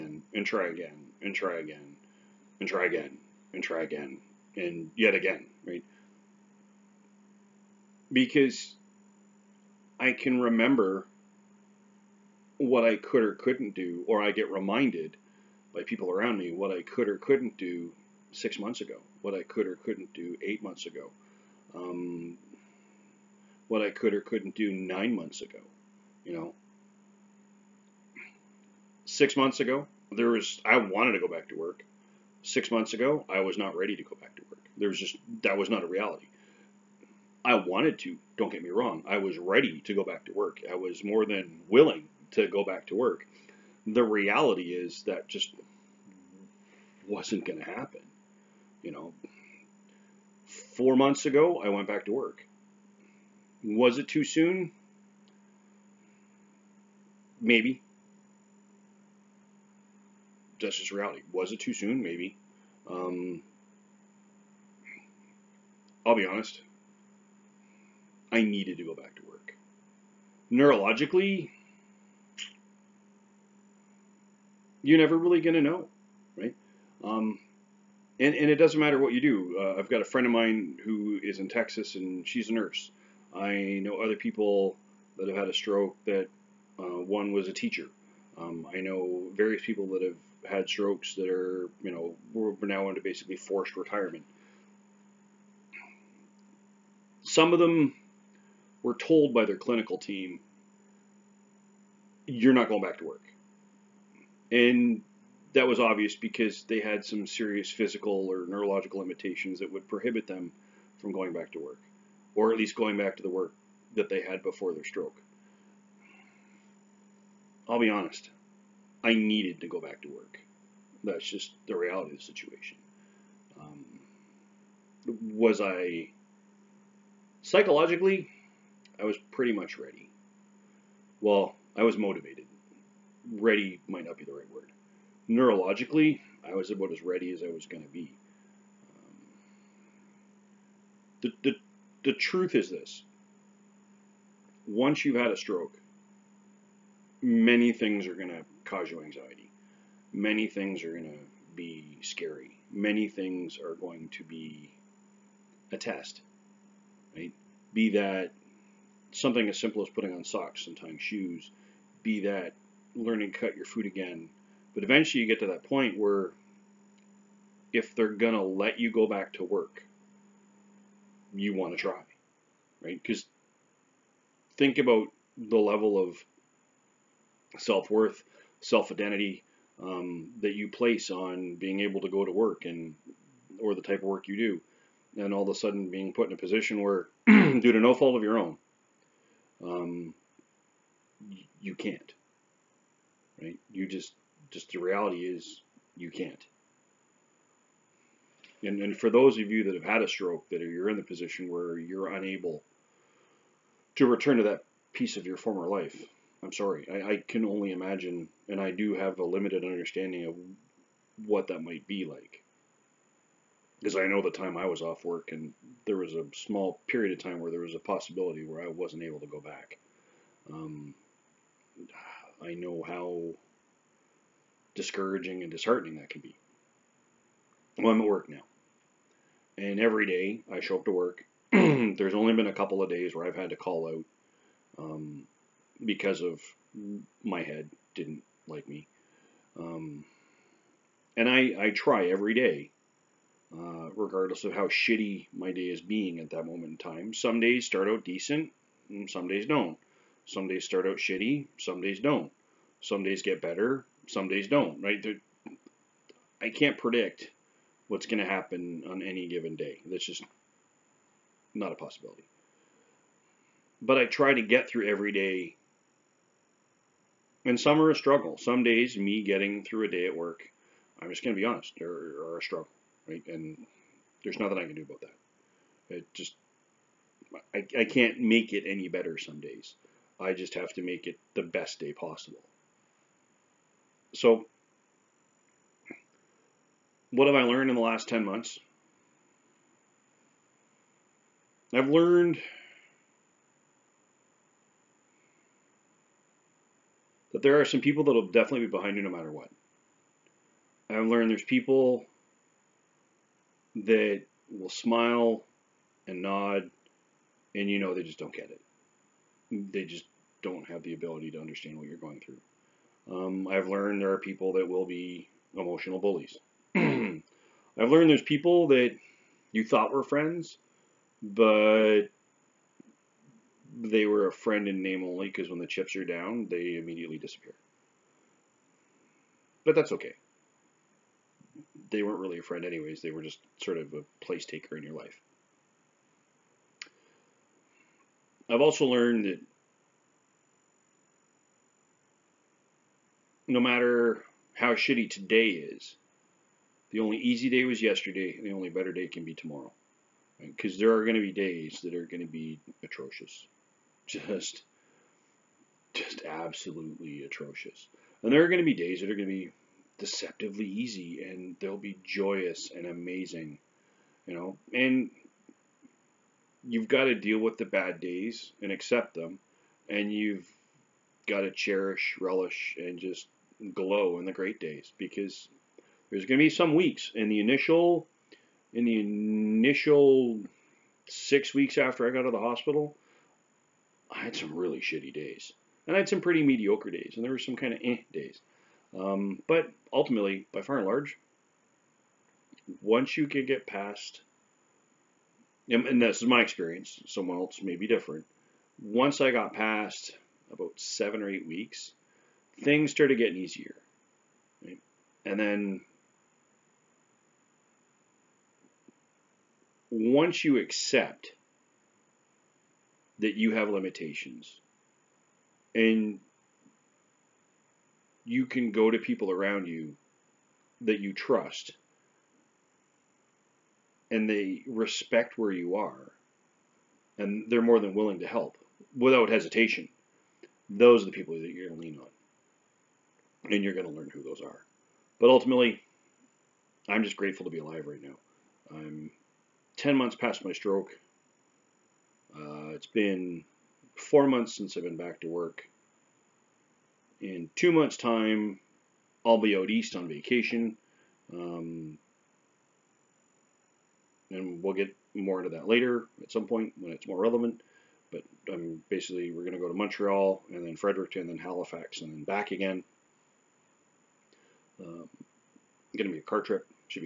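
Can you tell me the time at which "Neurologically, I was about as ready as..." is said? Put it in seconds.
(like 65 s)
135 s.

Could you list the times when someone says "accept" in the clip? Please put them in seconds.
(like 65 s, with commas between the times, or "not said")
368 s, 410 s.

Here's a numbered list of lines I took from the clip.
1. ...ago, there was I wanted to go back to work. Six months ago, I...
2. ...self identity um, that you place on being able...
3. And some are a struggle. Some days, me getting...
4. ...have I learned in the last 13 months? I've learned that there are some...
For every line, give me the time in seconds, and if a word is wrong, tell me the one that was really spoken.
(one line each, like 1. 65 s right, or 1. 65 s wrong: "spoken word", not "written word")
1. 29 s right
2. 178 s right
3. 267 s right
4. 287 s wrong: "10", not "13".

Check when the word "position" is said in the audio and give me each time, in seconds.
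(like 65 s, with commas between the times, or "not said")
186 s, 201 s.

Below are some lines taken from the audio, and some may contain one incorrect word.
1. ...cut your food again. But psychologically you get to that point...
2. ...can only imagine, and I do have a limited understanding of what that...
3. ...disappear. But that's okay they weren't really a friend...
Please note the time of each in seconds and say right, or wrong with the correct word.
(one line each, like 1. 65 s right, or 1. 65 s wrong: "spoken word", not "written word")
1. 163 s wrong: "eventually", not "psychologically"
2. 207 s right
3. 327 s right.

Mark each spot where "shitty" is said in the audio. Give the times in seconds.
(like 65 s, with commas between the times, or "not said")
244 s, 250 s, 344 s, 384 s.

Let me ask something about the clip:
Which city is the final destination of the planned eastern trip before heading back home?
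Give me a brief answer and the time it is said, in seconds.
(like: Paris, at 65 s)
Halifax, at 461 s.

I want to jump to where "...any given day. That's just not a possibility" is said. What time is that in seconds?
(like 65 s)
259 s.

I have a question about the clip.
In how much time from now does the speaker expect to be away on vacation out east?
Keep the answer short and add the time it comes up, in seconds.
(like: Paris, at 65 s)
2 months, at 447 s.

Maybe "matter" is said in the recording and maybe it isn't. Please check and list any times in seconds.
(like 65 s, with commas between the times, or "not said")
78 s, 299 s, 343 s.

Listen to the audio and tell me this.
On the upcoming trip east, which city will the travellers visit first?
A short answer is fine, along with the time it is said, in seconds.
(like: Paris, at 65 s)
Montreal, at 459 s.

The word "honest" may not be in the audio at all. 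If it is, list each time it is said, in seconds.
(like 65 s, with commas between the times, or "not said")
66 s, 117 s, 271 s.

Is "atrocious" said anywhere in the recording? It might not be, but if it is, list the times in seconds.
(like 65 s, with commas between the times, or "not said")
352 s, 357 s.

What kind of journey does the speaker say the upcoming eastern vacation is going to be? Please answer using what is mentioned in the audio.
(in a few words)
Car trip.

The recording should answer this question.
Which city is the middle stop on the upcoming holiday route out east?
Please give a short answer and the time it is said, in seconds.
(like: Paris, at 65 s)
Fredericton, at 460 s.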